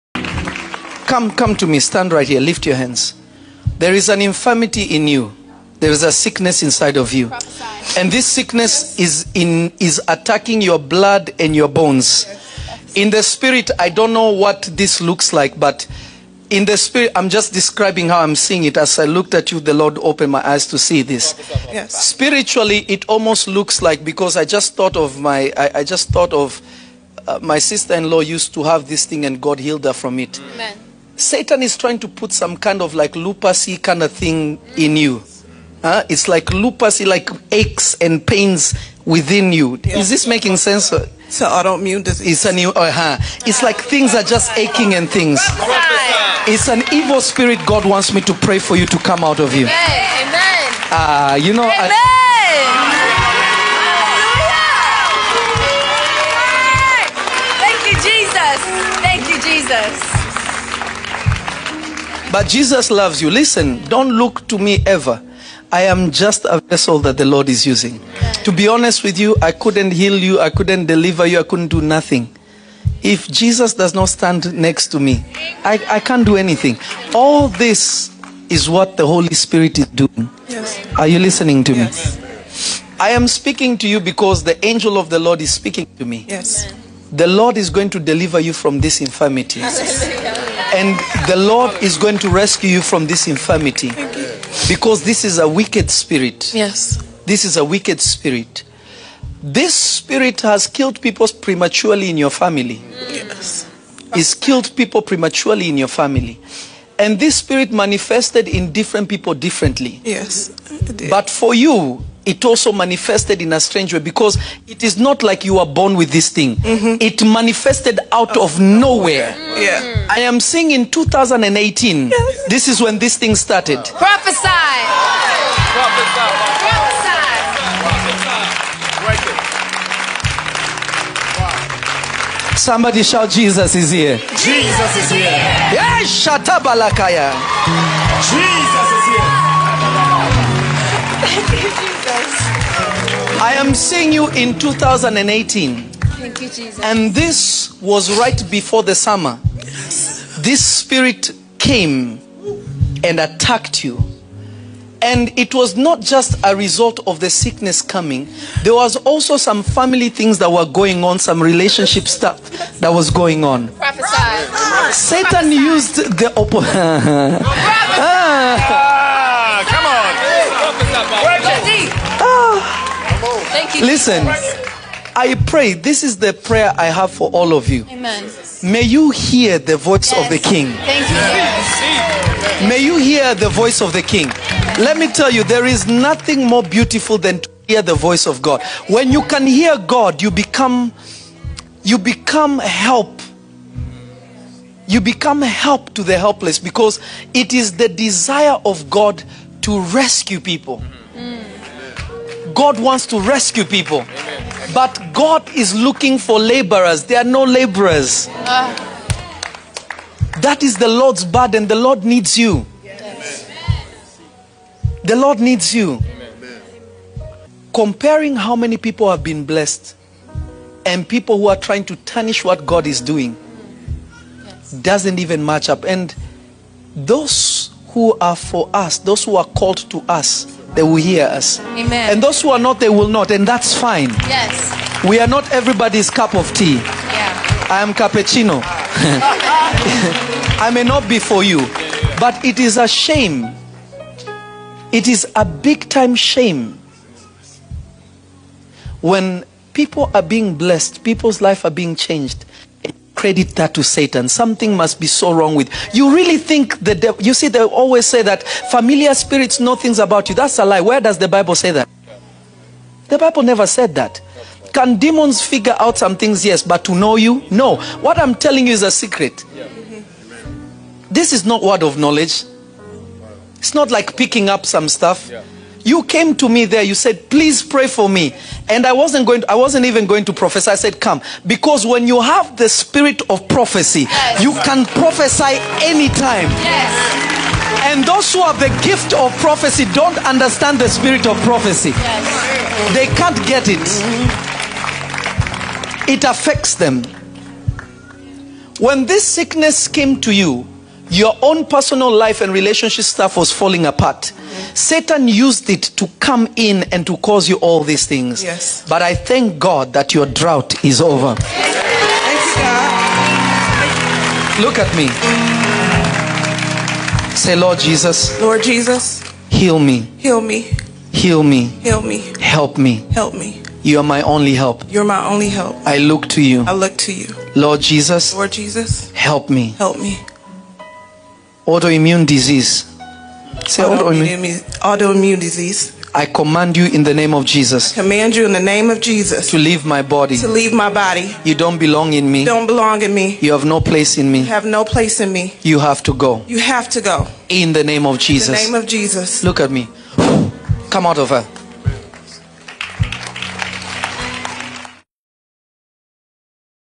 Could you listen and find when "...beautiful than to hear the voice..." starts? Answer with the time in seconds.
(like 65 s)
186 s.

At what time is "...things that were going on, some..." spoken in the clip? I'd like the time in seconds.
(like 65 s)
160 s.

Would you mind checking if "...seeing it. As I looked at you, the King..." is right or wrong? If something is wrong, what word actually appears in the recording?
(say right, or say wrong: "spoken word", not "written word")
wrong: "Lord", not "King".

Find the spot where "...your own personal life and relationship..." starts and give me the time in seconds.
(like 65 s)
301 s.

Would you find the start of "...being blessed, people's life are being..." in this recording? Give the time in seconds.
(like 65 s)
250 s.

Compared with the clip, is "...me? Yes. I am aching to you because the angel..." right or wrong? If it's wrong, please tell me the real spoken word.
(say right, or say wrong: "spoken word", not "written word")
wrong: "speaking", not "aching".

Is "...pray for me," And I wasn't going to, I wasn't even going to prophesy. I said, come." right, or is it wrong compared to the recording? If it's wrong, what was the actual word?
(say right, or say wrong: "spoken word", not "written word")
right.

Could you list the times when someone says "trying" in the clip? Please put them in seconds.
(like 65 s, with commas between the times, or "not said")
31 s, 221 s.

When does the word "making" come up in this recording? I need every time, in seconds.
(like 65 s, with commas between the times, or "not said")
40 s.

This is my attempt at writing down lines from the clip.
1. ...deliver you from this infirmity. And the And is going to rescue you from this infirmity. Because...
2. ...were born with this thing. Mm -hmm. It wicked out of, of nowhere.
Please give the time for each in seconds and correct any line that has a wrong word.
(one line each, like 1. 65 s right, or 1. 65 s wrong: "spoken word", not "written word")
1. 87 s wrong: "Lord", not "And"
2. 115 s wrong: "manifested", not "wicked".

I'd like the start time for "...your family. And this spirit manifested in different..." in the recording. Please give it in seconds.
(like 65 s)
105 s.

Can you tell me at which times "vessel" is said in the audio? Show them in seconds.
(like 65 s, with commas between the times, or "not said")
66 s.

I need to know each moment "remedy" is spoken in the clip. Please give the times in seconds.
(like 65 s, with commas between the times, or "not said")
not said.